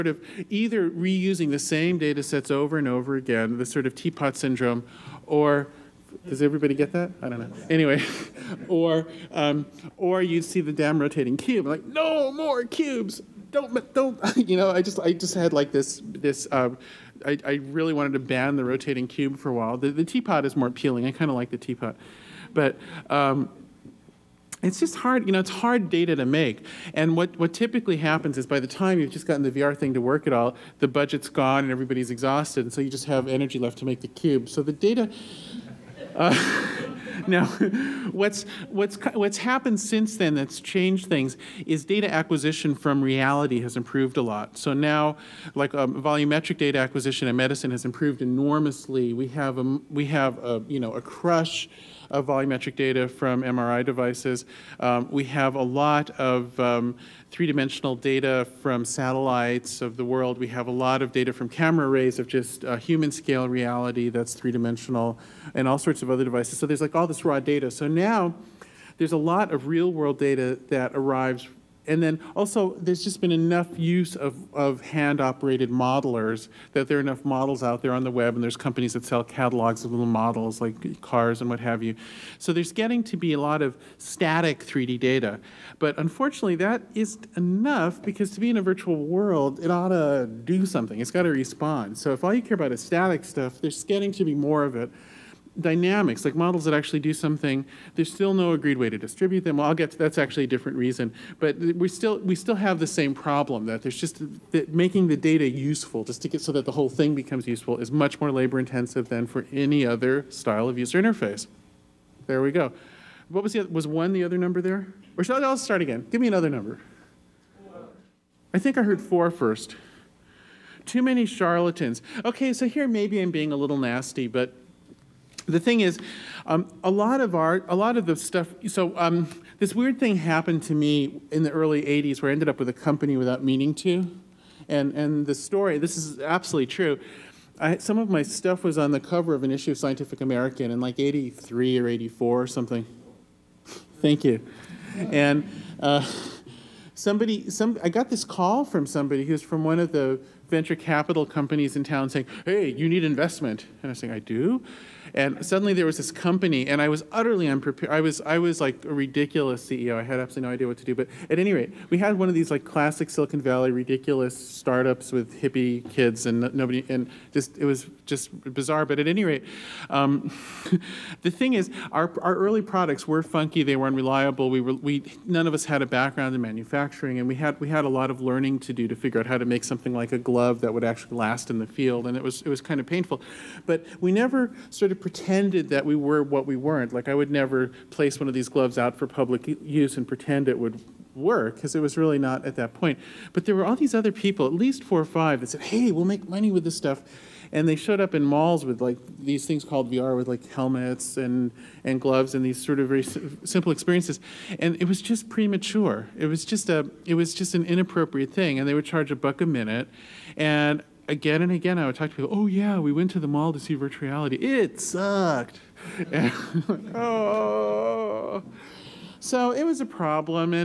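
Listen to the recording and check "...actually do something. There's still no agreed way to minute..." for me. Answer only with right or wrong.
wrong.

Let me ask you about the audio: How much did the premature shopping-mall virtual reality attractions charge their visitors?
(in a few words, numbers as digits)
A buck a minute.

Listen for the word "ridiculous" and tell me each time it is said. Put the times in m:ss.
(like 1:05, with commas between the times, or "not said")
2:38, 2:43.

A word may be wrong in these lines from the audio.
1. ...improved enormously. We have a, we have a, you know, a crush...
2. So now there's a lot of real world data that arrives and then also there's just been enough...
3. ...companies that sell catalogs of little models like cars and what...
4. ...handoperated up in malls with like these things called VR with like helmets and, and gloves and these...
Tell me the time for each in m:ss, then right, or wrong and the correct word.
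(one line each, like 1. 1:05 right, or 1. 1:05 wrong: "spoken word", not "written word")
1. 0:47 right
2. 1:07 right
3. 1:18 right
4. 3:17 wrong: "showed", not "handoperated".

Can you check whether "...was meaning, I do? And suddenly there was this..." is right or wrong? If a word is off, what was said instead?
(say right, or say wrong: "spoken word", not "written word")
wrong: "saying", not "meaning".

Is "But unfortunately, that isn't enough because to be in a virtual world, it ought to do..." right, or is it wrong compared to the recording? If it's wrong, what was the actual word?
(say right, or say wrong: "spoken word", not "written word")
right.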